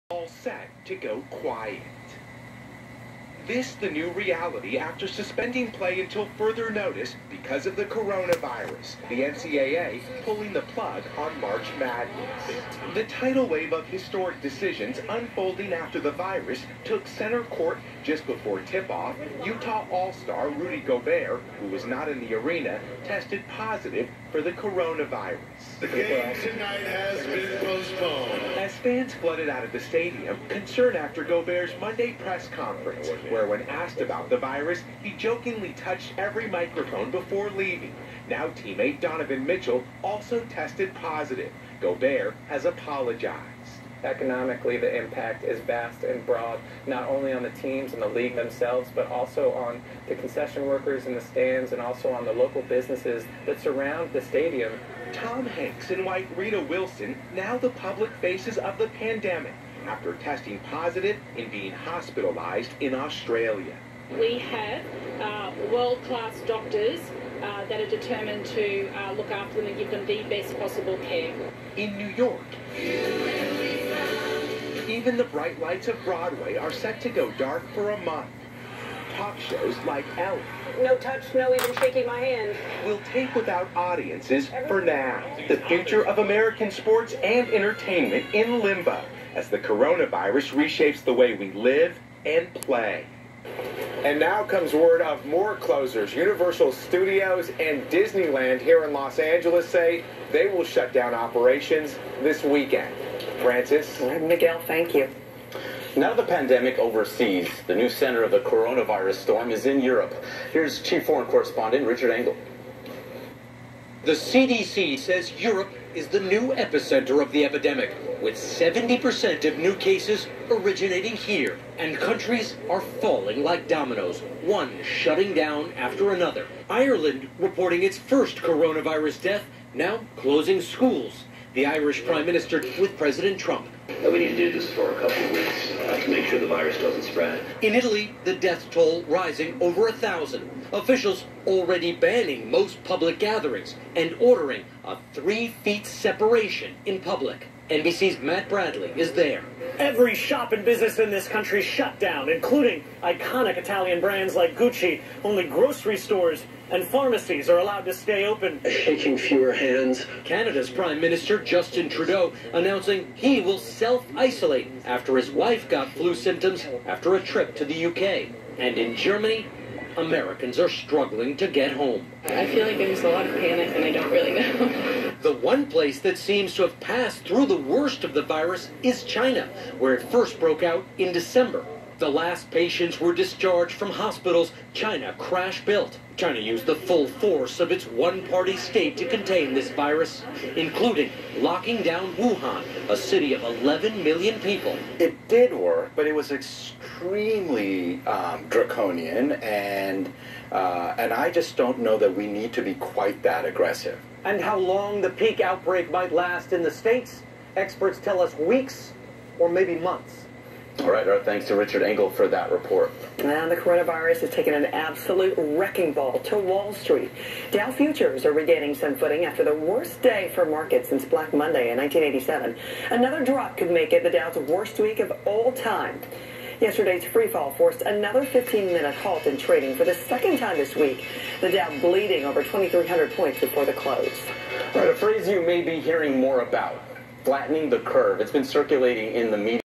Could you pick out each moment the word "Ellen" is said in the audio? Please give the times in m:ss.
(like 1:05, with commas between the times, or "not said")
1:20.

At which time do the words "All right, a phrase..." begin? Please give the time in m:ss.
3:54.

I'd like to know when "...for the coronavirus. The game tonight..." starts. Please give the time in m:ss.
0:24.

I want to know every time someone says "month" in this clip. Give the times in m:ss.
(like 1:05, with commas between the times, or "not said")
1:18, 3:29.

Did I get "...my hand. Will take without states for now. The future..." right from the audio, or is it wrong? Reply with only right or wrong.
wrong.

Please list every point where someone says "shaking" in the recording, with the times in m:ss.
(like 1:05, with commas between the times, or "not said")
1:21, 2:38.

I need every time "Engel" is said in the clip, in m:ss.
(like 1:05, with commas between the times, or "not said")
1:52, 3:31.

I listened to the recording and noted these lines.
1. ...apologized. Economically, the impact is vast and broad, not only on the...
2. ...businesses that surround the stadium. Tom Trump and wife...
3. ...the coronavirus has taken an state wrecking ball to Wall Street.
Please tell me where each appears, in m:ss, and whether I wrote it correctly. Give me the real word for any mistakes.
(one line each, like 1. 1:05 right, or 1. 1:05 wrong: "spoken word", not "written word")
1. 0:42 right
2. 0:52 wrong: "Hanks", not "Trump"
3. 3:33 wrong: "absolute", not "state".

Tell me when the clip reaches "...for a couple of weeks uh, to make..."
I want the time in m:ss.
2:14.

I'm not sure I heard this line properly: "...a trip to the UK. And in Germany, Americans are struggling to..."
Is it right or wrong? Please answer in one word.
right.